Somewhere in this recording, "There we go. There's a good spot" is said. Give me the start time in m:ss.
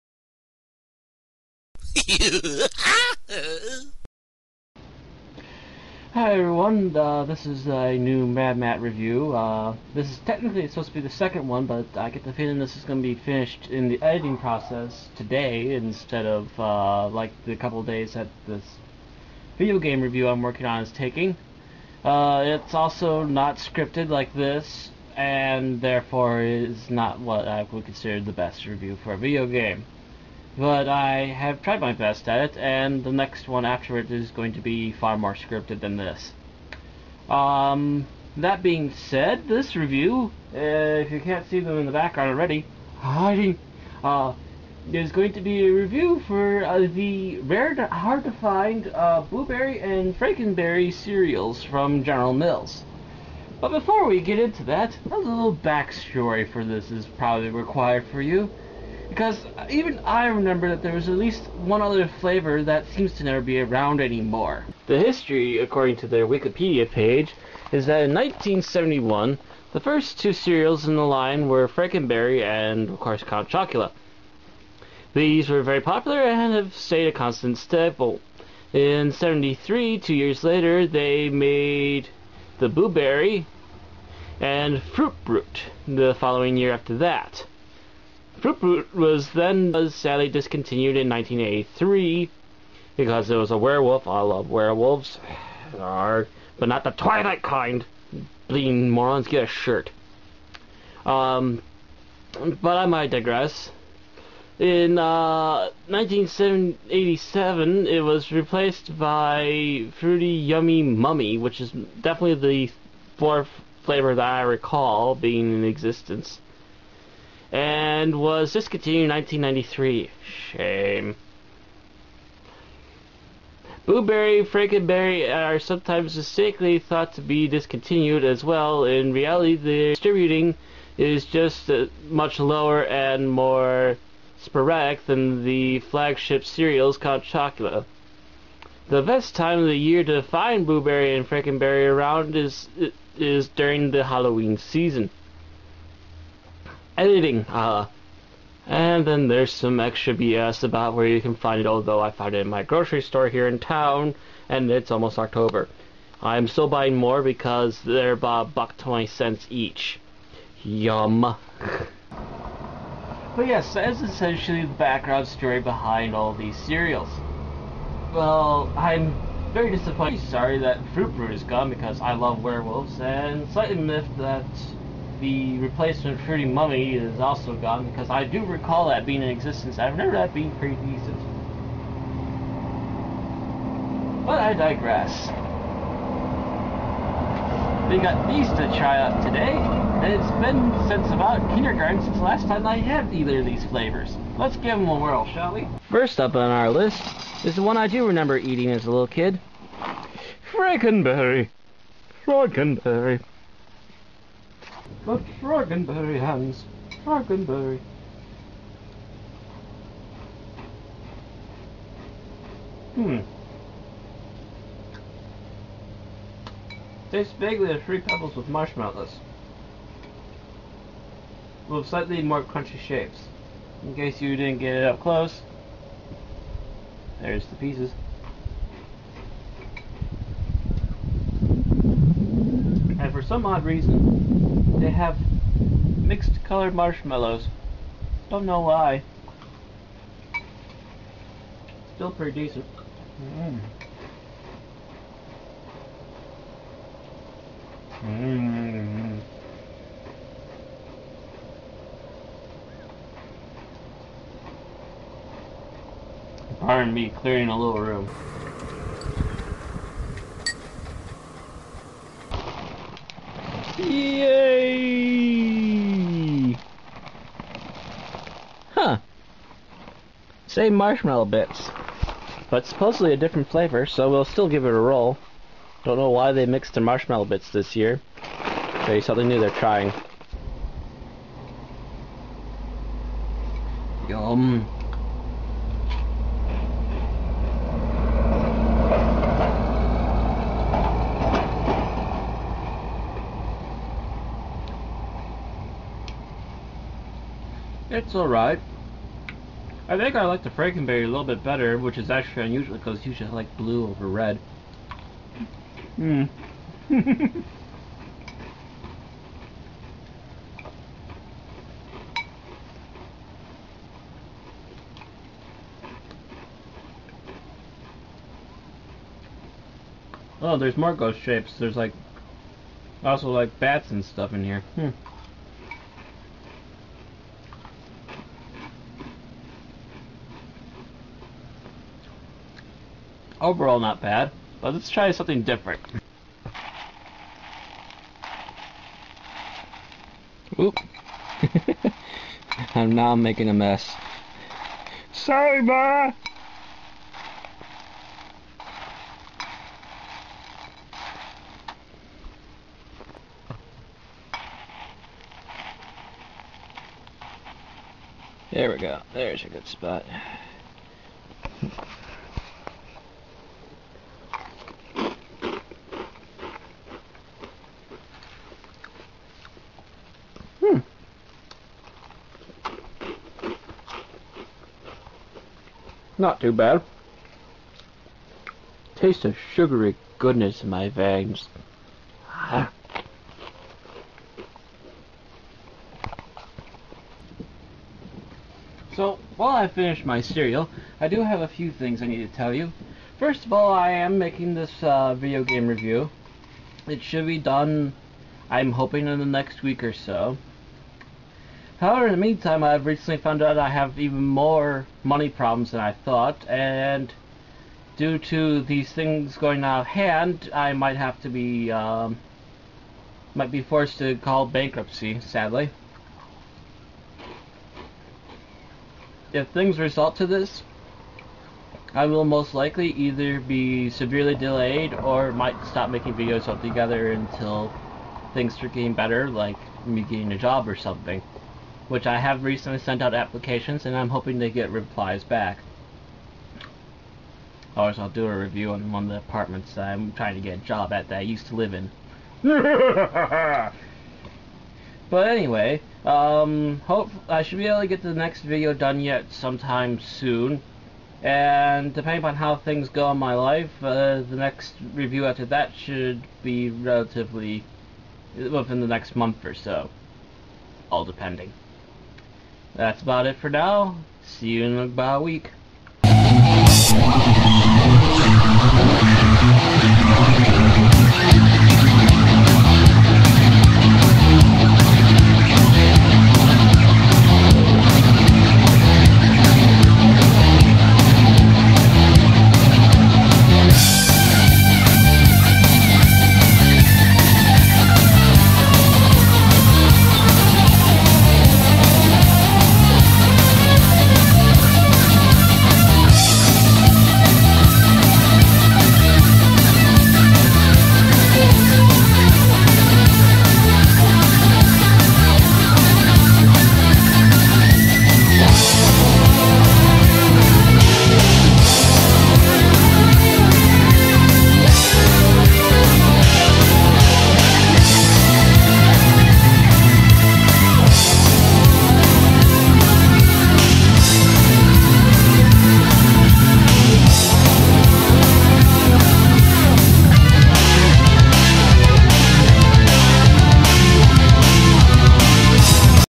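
5:58.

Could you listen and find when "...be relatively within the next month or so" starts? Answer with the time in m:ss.
7:36.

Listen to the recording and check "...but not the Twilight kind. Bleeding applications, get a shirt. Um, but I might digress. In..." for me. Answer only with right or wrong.
wrong.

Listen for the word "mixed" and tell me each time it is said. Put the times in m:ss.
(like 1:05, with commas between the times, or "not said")
3:55, 4:36.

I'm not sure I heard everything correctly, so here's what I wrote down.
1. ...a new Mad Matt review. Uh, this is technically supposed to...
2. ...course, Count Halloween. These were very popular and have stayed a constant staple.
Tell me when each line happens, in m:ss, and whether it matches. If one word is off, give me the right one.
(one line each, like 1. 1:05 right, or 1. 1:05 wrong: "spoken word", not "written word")
1. 0:07 right
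2. 1:13 wrong: "Chocula", not "Halloween".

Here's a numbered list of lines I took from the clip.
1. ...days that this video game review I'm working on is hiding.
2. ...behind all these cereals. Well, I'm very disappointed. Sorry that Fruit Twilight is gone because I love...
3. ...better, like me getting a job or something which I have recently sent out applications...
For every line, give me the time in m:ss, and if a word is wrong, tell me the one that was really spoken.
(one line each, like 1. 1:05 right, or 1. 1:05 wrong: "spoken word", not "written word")
1. 0:17 wrong: "taking", not "hiding"
2. 2:45 wrong: "Brute", not "Twilight"
3. 7:08 right.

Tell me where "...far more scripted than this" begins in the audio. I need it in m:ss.
0:34.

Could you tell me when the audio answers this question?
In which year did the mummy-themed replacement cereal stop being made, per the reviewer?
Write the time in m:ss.
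1:59.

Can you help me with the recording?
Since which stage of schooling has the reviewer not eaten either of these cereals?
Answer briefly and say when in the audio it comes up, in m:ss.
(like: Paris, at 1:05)
kindergarten, at 3:11.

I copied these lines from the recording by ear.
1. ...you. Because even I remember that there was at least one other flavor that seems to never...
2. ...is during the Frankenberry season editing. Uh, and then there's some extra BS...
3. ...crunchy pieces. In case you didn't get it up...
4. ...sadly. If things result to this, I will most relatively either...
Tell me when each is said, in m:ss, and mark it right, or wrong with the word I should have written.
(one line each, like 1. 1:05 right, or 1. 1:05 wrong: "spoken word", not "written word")
1. 0:58 right
2. 2:23 wrong: "Halloween", not "Frankenberry"
3. 3:42 wrong: "shapes", not "pieces"
4. 6:55 wrong: "likely", not "relatively".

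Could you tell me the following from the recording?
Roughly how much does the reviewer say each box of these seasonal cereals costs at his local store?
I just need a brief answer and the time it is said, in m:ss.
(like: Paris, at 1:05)
$1.20, at 2:38.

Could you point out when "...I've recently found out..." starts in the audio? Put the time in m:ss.
6:42.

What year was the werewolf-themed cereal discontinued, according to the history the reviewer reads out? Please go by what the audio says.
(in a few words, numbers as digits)
1983.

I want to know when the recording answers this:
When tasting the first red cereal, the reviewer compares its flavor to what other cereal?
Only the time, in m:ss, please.
3:38.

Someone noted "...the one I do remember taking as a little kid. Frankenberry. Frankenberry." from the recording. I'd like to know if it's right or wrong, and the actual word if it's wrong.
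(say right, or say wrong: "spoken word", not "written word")
wrong: "eating", not "taking".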